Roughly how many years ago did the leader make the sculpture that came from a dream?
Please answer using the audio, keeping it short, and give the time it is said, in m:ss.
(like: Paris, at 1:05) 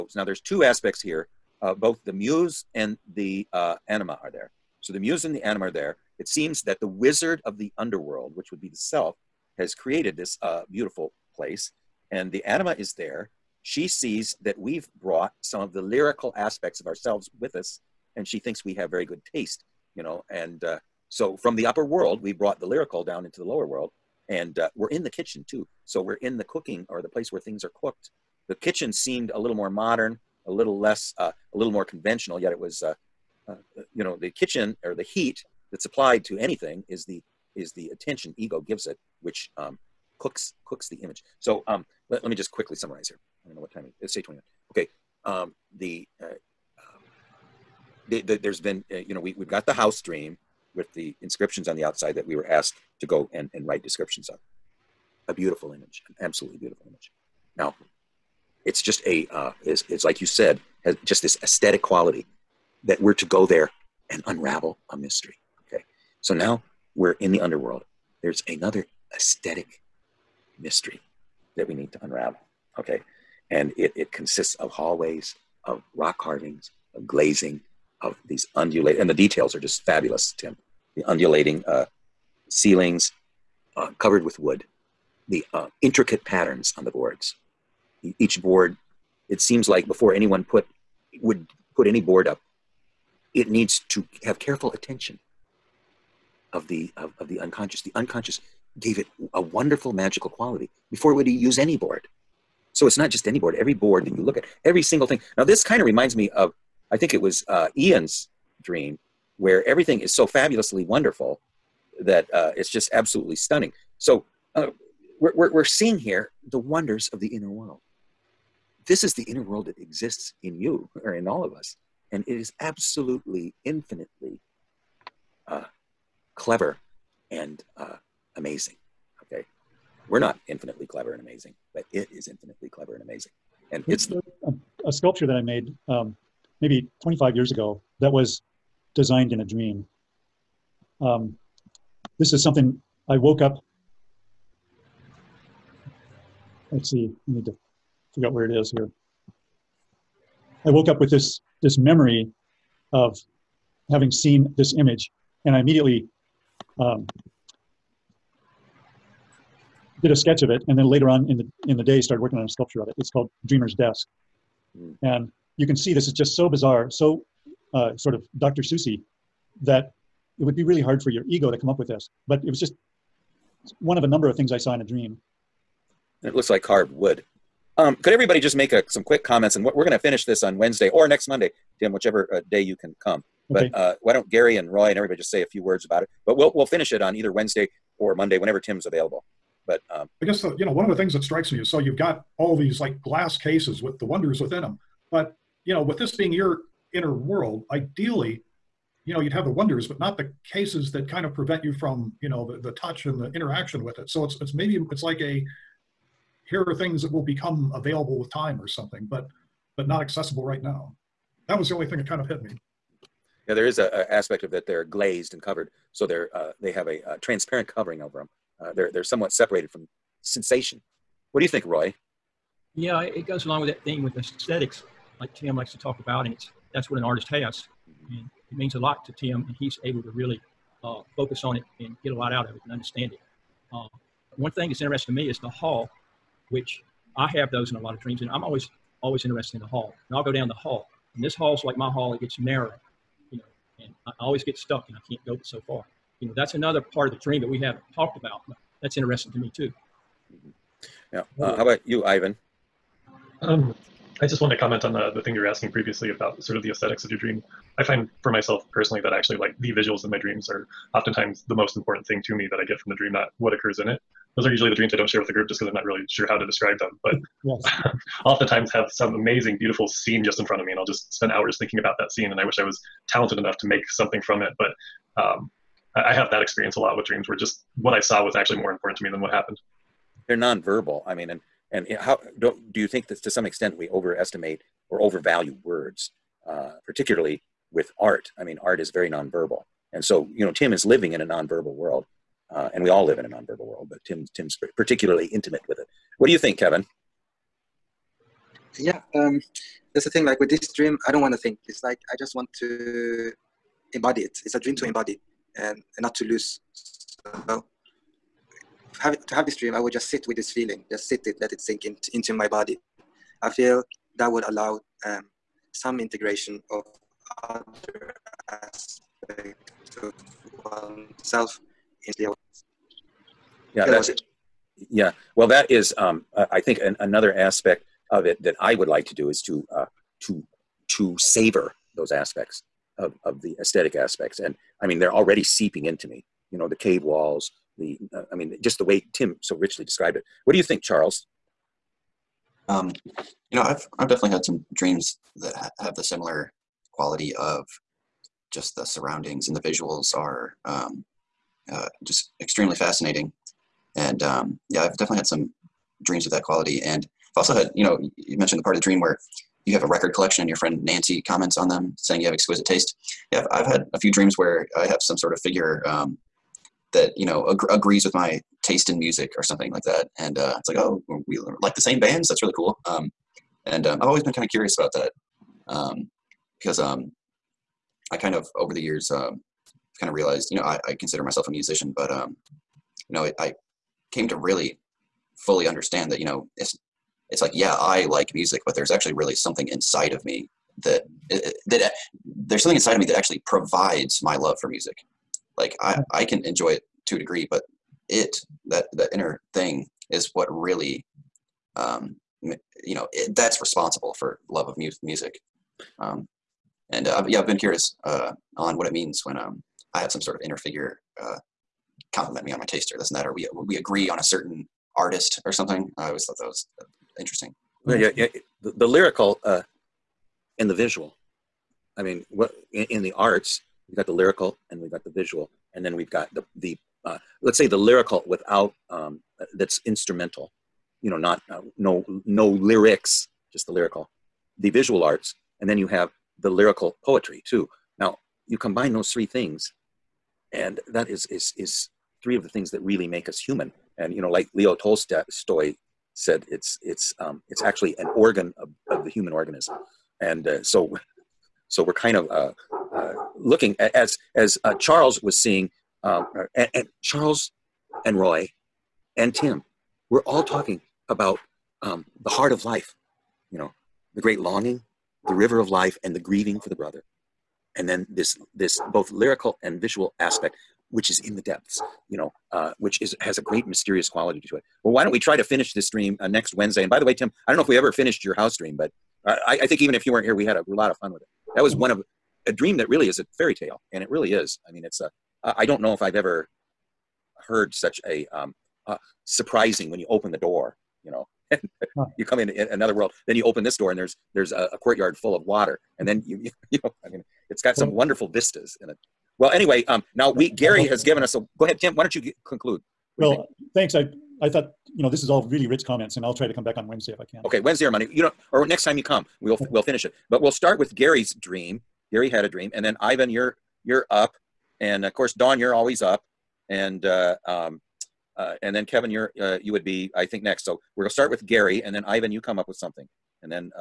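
25, at 2:17.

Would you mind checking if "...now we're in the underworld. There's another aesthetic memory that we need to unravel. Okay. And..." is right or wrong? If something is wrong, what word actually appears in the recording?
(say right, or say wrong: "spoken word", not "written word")
wrong: "mystery", not "memory".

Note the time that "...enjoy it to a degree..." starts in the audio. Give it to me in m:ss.
6:36.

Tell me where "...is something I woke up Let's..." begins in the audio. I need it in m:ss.
2:22.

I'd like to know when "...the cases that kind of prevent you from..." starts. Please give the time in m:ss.
3:20.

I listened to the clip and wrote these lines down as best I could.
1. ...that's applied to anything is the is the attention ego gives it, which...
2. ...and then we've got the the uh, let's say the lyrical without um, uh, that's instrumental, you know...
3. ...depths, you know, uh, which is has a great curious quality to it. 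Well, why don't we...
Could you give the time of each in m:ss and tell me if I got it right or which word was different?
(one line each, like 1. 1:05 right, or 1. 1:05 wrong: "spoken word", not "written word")
1. 0:35 right
2. 7:05 right
3. 7:51 wrong: "mysterious", not "curious".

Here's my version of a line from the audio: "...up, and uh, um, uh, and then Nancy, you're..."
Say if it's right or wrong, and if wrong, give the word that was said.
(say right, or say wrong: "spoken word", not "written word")
wrong: "Kevin", not "Nancy".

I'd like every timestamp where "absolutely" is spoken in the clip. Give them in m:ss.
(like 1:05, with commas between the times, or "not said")
0:56, 1:52, 2:02.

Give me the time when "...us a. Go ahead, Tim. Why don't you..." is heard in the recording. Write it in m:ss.
8:21.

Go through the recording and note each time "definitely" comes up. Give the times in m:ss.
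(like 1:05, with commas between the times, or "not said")
5:44, 5:54.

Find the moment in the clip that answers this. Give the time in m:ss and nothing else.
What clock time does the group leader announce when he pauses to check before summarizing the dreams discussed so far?
0:44.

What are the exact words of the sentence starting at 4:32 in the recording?
And I wish I was talented enough to make something from it.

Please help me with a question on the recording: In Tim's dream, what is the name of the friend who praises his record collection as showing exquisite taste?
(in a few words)
Nancy.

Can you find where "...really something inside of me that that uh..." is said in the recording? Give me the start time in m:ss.
6:29.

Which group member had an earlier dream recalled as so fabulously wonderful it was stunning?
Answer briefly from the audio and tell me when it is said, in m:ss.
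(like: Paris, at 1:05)
Ian, at 1:47.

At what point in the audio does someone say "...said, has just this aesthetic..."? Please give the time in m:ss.
1:00.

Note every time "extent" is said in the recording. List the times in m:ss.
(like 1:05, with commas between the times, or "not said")
4:43.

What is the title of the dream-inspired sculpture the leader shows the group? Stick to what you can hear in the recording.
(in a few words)
Dreamer's Desk.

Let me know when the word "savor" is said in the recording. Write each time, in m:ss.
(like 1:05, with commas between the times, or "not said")
5:31.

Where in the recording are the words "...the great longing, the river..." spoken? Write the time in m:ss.
7:44.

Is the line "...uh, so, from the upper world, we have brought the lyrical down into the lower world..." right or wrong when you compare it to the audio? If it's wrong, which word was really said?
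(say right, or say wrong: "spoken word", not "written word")
right.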